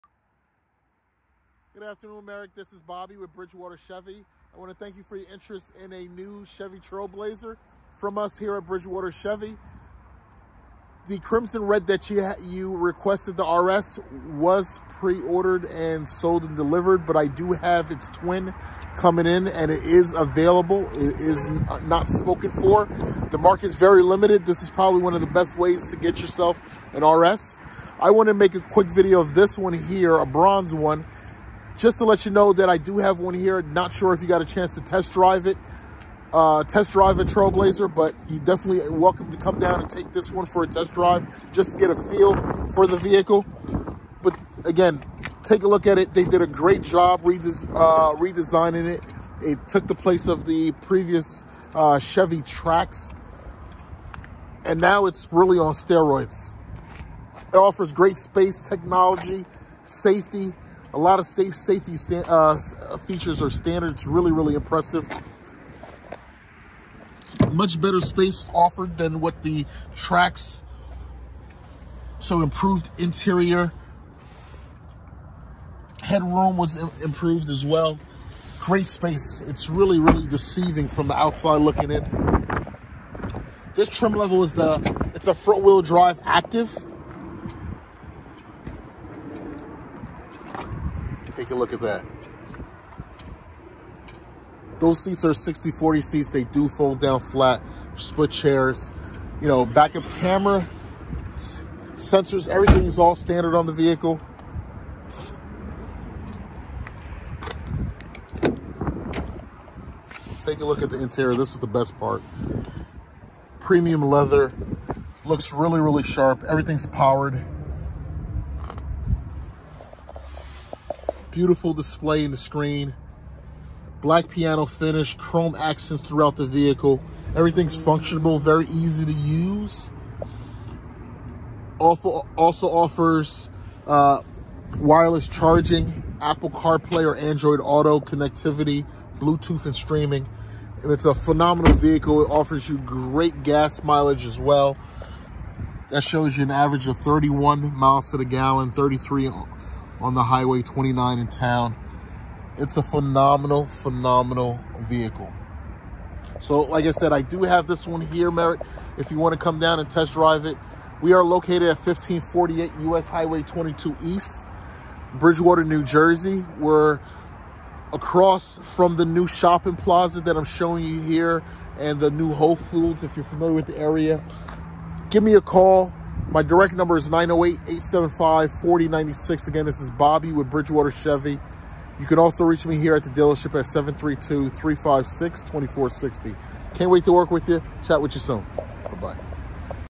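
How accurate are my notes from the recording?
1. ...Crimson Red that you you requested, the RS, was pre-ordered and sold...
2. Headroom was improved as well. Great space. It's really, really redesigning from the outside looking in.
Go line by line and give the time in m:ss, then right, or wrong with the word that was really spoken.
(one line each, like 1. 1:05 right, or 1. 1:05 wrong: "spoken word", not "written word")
1. 0:11 right
2. 1:16 wrong: "deceiving", not "redesigning".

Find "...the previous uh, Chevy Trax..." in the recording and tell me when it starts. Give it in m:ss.
0:50.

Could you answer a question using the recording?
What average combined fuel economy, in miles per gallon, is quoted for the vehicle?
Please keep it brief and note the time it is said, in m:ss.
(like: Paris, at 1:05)
31, at 2:26.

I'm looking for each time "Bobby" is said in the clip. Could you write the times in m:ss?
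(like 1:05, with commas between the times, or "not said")
0:02, 2:59.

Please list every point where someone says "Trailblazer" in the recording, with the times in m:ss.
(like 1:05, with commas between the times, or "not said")
0:06, 0:37.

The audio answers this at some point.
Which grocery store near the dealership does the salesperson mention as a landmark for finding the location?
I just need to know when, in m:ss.
2:52.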